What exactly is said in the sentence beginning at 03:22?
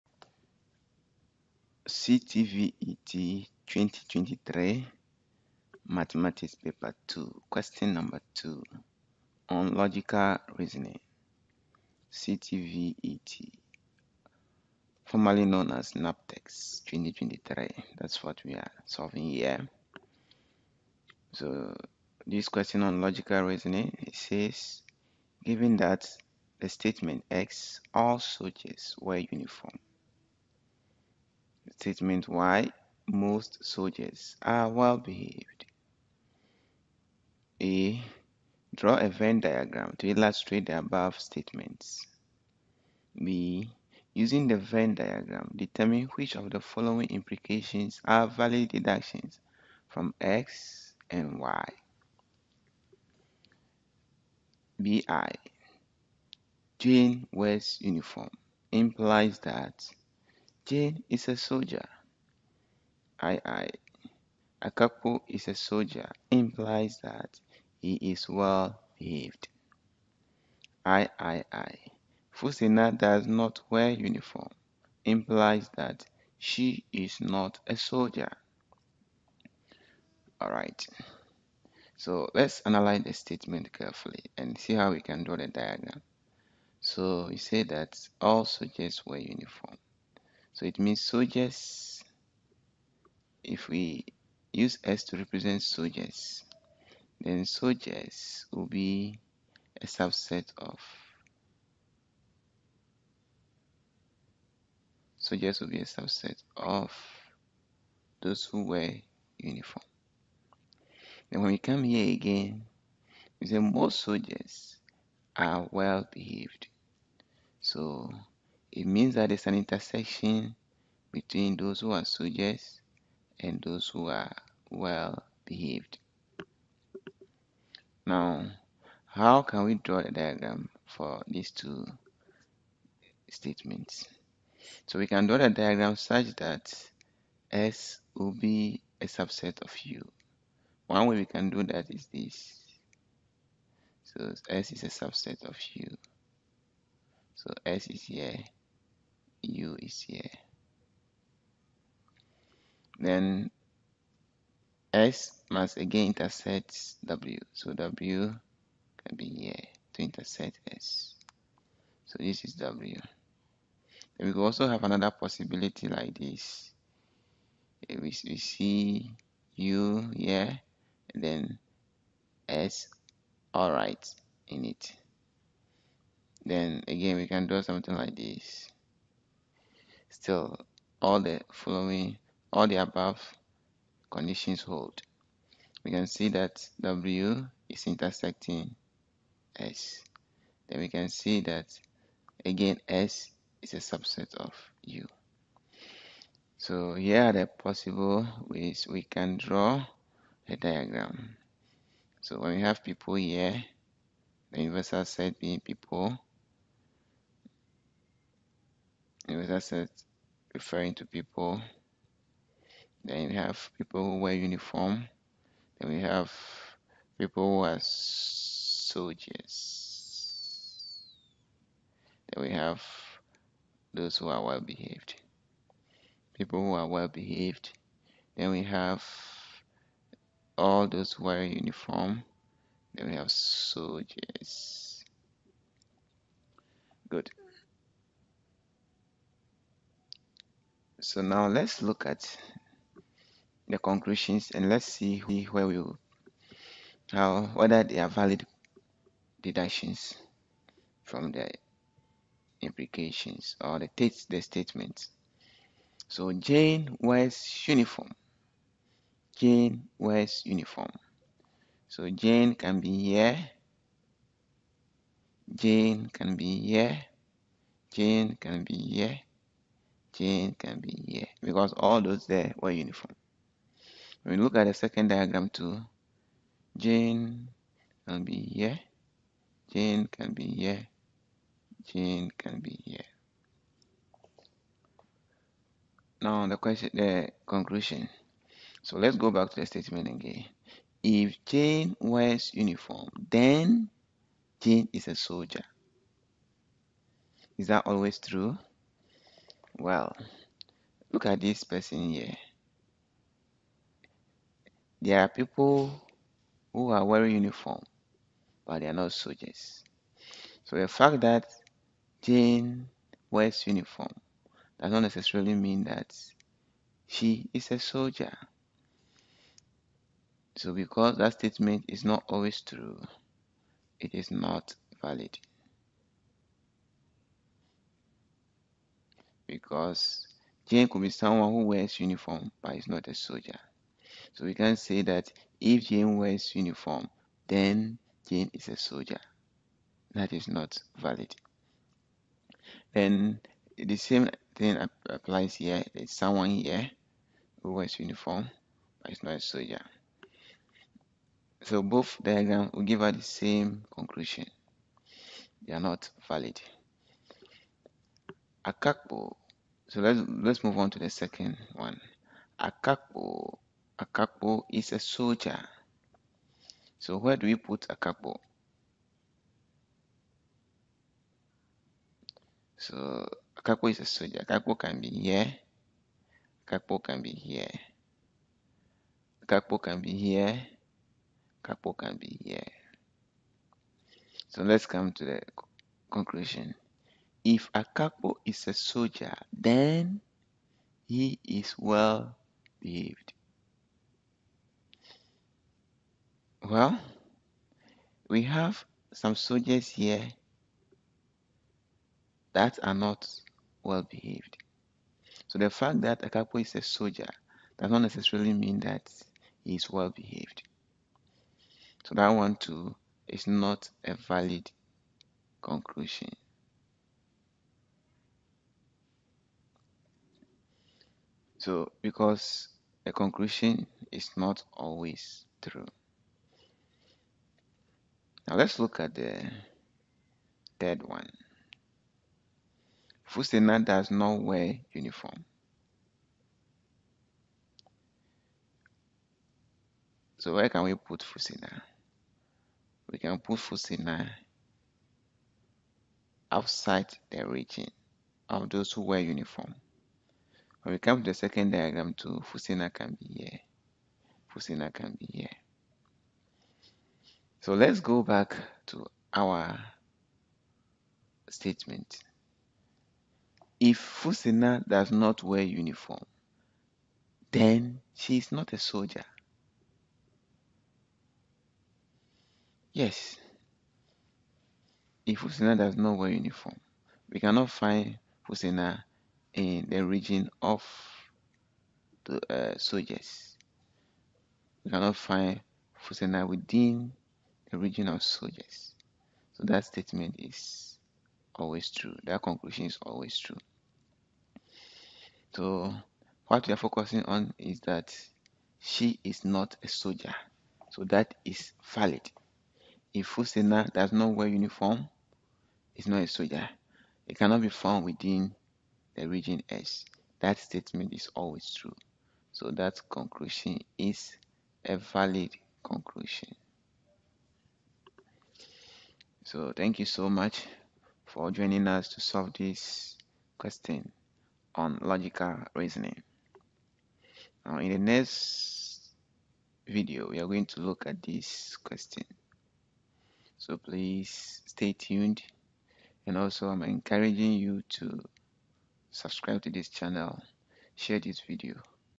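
So when we have people here, the universal set being people, a user set referring to people.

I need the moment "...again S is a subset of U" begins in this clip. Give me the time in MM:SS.
03:12.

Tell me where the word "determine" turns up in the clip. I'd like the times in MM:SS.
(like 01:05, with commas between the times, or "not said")
00:45.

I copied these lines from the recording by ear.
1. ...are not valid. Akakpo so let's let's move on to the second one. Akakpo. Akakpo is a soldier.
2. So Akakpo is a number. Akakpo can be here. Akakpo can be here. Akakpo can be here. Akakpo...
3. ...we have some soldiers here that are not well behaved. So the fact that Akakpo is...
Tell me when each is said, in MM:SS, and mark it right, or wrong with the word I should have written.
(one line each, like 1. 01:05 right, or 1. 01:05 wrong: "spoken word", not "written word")
1. 05:55 right
2. 06:12 wrong: "soldier", not "number"
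3. 06:38 right.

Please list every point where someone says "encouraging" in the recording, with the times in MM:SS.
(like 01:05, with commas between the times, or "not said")
08:56.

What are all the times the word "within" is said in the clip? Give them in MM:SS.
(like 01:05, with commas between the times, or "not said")
08:06, 08:28.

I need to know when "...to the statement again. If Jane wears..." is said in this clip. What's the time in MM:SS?
04:49.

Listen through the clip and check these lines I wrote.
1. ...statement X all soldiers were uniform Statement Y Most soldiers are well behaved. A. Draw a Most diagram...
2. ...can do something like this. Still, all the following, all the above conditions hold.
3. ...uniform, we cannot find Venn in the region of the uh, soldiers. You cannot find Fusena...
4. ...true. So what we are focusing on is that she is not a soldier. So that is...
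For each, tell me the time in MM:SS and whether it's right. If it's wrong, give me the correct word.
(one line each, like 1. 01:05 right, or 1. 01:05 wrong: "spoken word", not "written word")
1. 00:26 wrong: "Venn", not "Most"
2. 02:57 right
3. 07:56 wrong: "Fusina", not "Venn"
4. 08:13 right.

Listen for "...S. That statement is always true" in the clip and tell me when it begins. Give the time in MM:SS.
08:29.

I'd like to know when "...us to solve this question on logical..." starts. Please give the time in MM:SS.
08:41.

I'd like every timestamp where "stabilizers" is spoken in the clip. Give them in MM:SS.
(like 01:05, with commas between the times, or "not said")
not said.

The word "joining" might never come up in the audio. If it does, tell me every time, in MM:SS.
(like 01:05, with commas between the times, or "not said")
08:41.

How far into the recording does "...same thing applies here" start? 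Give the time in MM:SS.
05:43.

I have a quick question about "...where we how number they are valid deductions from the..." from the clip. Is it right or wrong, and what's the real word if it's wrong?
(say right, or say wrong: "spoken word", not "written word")
wrong: "whether", not "number".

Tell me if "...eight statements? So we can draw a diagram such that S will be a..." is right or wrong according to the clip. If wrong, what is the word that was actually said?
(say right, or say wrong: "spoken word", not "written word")
wrong: "two", not "eight".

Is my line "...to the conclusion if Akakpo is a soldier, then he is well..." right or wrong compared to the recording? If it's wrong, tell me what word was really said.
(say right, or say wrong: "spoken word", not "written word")
right.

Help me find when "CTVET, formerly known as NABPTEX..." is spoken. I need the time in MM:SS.
00:12.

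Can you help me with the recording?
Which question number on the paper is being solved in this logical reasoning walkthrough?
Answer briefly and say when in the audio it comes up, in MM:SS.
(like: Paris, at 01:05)
2, at 00:07.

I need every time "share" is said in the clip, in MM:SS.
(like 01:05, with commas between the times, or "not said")
09:00.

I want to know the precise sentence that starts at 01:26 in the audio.
So we say that all soldiers wear uniform.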